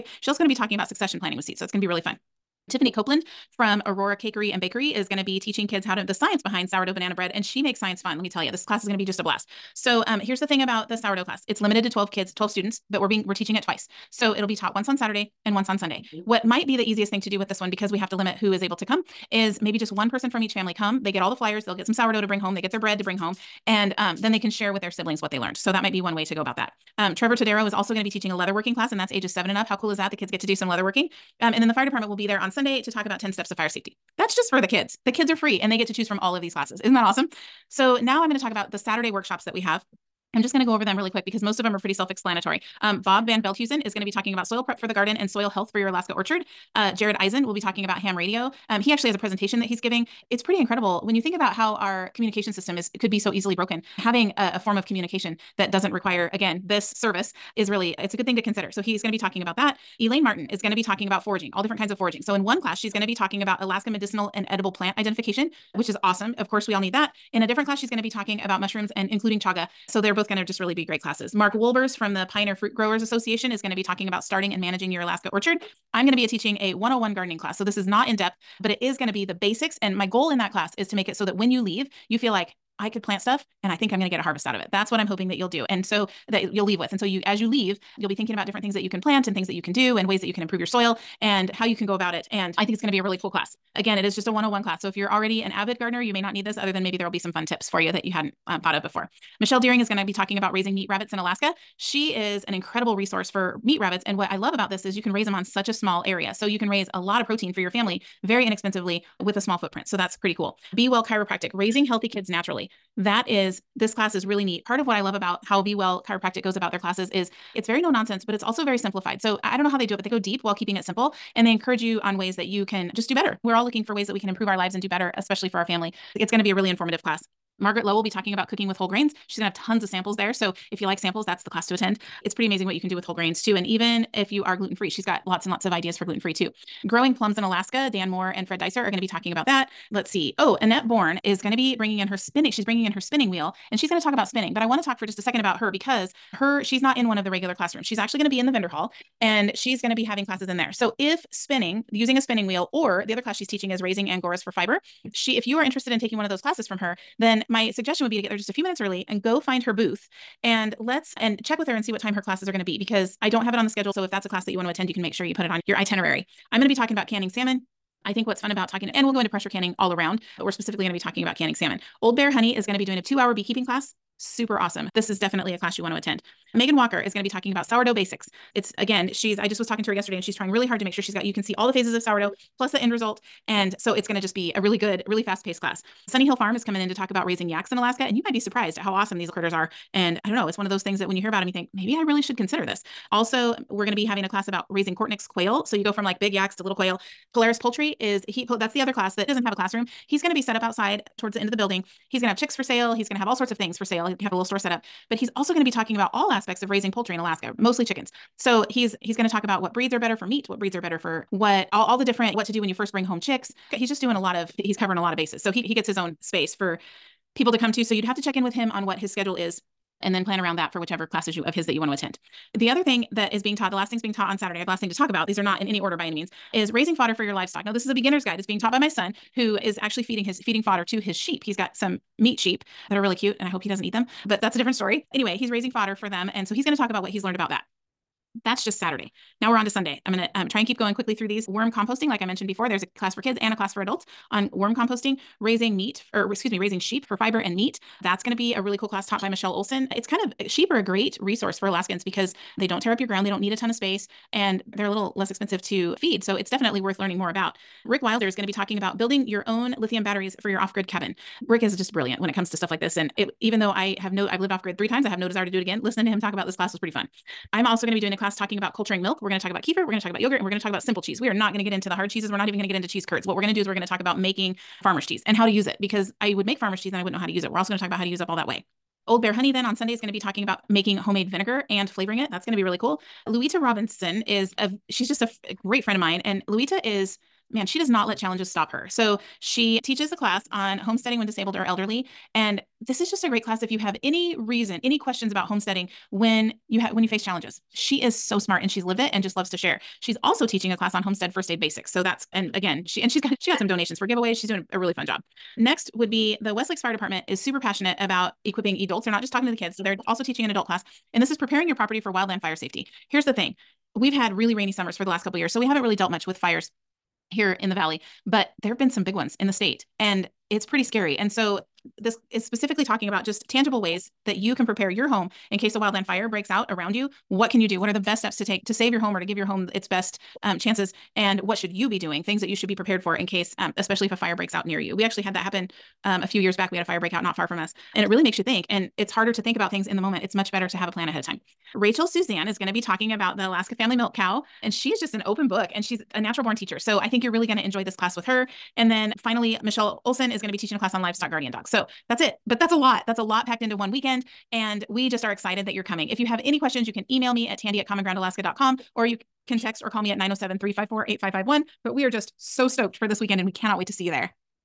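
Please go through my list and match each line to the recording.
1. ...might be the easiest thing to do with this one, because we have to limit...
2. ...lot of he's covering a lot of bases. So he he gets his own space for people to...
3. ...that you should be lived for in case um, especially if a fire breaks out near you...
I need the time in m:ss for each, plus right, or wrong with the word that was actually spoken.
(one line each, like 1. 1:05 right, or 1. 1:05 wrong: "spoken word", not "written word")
1. 0:16 right
2. 3:34 right
3. 5:32 wrong: "prepared", not "lived".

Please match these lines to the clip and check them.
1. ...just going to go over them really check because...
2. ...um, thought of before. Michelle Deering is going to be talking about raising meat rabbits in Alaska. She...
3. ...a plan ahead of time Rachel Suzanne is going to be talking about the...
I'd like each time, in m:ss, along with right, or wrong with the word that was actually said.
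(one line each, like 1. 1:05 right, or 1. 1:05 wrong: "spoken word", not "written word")
1. 0:40 wrong: "quick", not "check"
2. 1:38 right
3. 5:40 right.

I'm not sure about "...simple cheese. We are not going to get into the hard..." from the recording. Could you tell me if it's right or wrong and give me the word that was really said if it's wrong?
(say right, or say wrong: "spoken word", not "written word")
right.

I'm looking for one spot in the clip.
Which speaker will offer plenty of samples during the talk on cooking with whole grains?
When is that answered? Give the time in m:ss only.
2:07.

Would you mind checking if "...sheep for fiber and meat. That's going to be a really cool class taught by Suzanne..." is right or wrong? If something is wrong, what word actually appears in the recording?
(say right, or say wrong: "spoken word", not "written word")
wrong: "Michelle", not "Suzanne".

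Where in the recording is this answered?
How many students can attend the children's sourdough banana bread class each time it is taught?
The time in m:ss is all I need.
0:12.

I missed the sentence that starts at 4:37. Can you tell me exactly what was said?
We're also going to talk about how to use up all that whey.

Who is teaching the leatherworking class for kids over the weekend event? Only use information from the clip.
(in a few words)
Trevor Tadero.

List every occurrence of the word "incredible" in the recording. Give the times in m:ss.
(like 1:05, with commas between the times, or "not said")
0:50, 1:42.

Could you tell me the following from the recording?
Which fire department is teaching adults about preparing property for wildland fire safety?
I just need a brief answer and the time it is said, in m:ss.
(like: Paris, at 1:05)
Westlakes Fire Department, at 5:06.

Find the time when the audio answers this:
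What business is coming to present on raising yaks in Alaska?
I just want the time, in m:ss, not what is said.
3:06.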